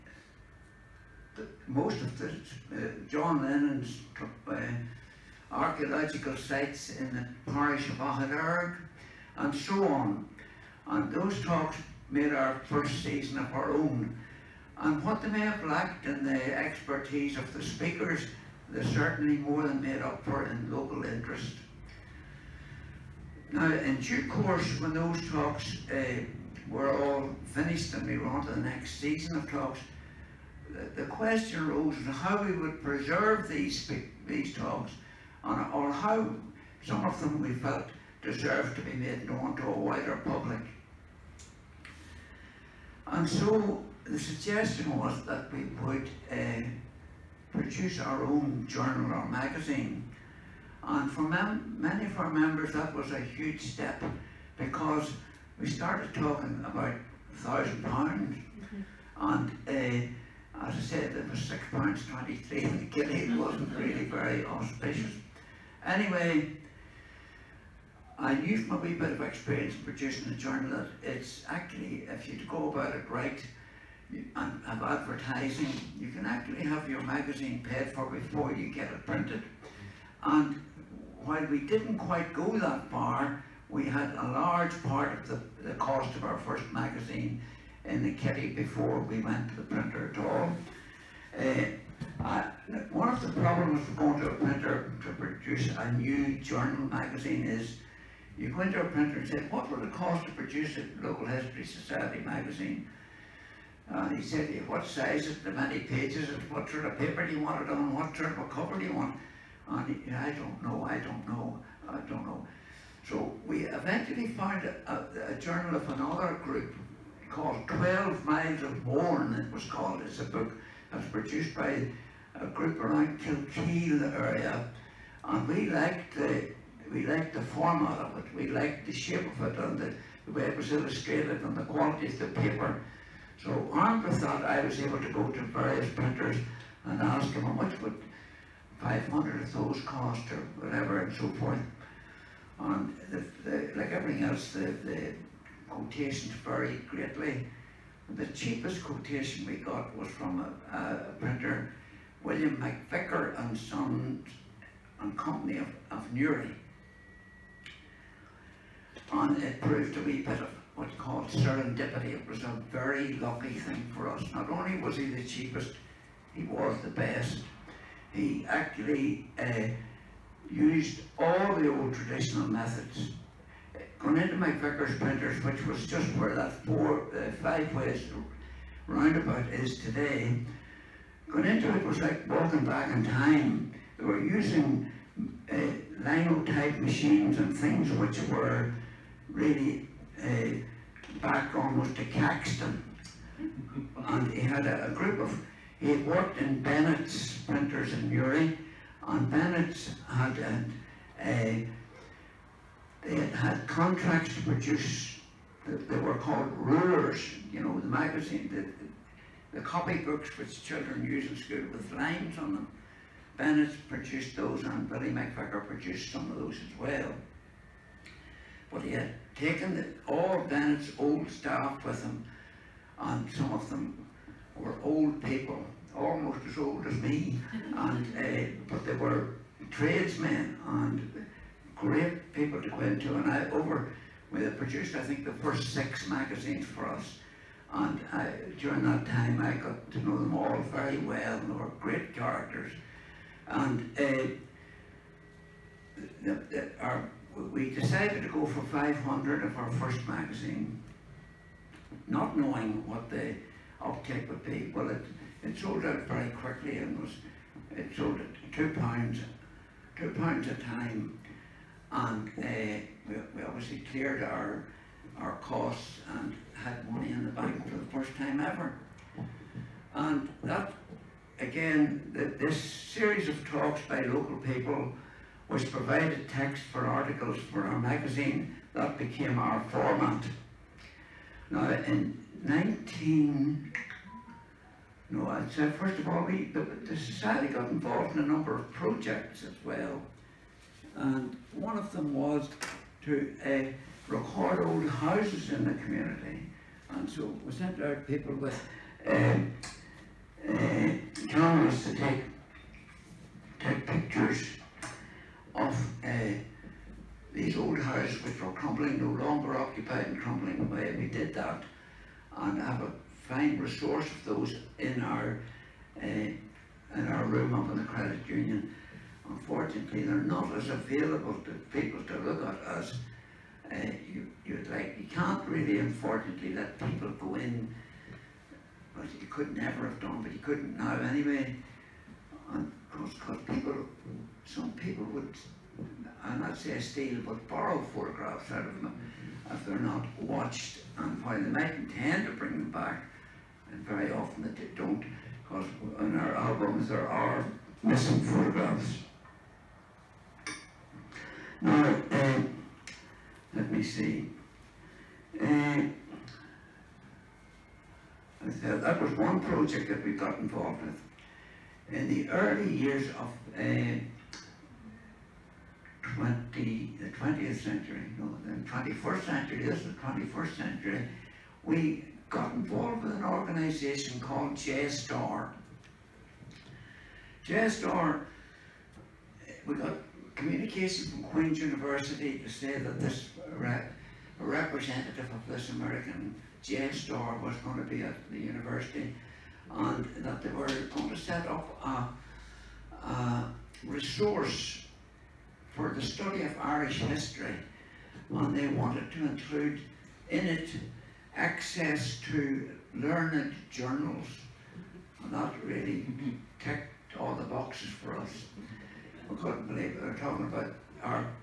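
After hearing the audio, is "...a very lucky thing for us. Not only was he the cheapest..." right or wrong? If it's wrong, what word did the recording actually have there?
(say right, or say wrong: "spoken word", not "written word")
right.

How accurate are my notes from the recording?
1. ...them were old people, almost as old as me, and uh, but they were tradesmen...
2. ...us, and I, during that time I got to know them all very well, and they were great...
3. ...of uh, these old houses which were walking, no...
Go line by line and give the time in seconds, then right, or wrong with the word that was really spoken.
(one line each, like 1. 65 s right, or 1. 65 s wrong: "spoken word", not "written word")
1. 223 s right
2. 236 s right
3. 305 s wrong: "crumbling", not "walking".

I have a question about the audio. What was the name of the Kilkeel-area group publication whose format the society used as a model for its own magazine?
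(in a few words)
12 Miles of Mourne.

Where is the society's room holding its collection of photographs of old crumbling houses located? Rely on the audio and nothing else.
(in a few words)
the credit union.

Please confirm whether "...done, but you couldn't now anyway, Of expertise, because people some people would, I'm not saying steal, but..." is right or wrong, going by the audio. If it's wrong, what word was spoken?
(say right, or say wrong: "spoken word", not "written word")
wrong: "course", not "expertise".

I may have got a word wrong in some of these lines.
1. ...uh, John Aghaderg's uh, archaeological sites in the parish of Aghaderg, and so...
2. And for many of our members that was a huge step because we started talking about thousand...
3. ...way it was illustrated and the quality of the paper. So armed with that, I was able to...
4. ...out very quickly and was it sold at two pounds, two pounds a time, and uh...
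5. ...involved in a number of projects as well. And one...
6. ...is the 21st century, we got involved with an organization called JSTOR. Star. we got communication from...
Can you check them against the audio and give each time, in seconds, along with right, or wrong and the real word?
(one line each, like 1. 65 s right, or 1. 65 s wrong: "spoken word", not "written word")
1. 2 s wrong: "Lennon", not "Aghaderg"
2. 50 s right
3. 130 s right
4. 255 s right
5. 287 s right
6. 369 s right.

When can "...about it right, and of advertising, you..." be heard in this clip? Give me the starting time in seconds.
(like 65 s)
72 s.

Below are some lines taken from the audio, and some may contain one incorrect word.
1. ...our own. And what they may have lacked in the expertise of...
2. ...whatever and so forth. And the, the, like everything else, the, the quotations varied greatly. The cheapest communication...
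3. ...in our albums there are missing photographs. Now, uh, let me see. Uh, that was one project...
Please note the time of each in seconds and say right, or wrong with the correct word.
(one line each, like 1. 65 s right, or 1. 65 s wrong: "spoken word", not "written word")
1. 13 s right
2. 140 s wrong: "quotation", not "communication"
3. 345 s right.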